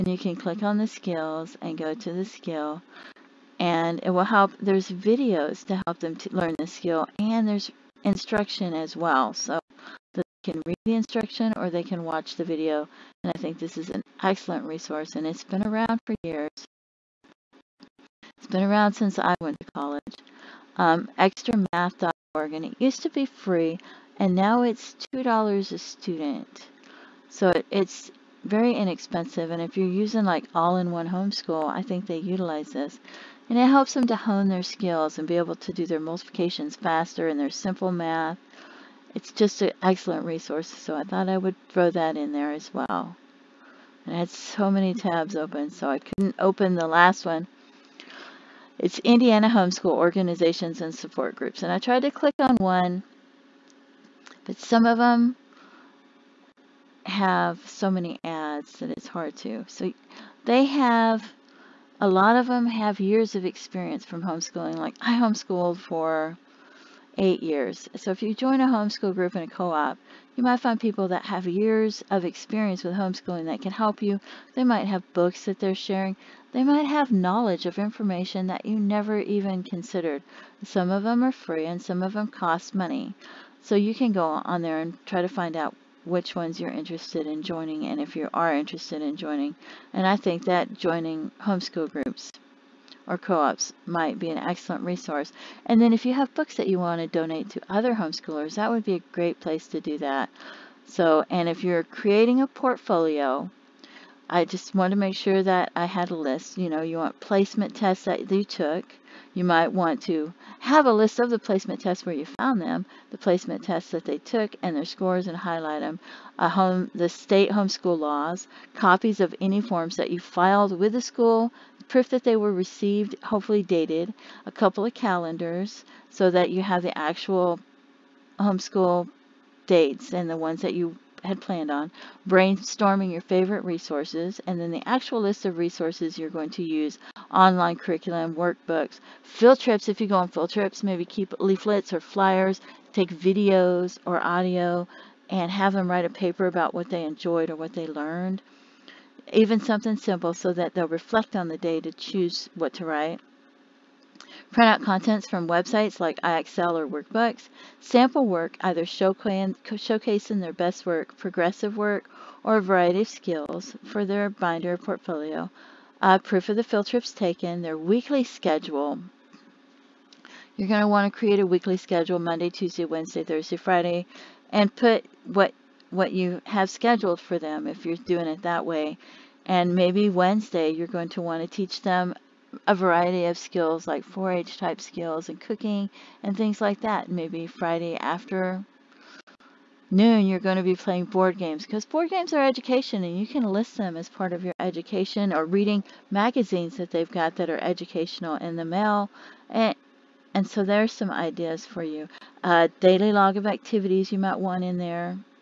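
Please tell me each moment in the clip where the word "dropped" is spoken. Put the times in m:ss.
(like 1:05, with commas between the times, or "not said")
not said.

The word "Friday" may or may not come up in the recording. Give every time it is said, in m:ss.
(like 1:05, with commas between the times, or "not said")
2:53, 3:07.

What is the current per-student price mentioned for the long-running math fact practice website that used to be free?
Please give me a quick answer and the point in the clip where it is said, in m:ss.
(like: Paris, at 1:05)
$2, at 0:25.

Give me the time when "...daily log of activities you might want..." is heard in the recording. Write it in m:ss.
3:22.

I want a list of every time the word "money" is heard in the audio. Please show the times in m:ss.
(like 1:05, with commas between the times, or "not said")
1:22.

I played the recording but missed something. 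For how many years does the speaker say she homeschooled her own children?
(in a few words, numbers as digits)
8.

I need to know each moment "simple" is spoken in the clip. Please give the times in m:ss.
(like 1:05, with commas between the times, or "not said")
0:37, 2:29.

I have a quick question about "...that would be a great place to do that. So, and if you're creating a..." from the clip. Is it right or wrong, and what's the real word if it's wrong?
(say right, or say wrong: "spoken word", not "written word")
right.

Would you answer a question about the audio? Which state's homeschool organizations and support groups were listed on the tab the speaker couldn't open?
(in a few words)
Indiana.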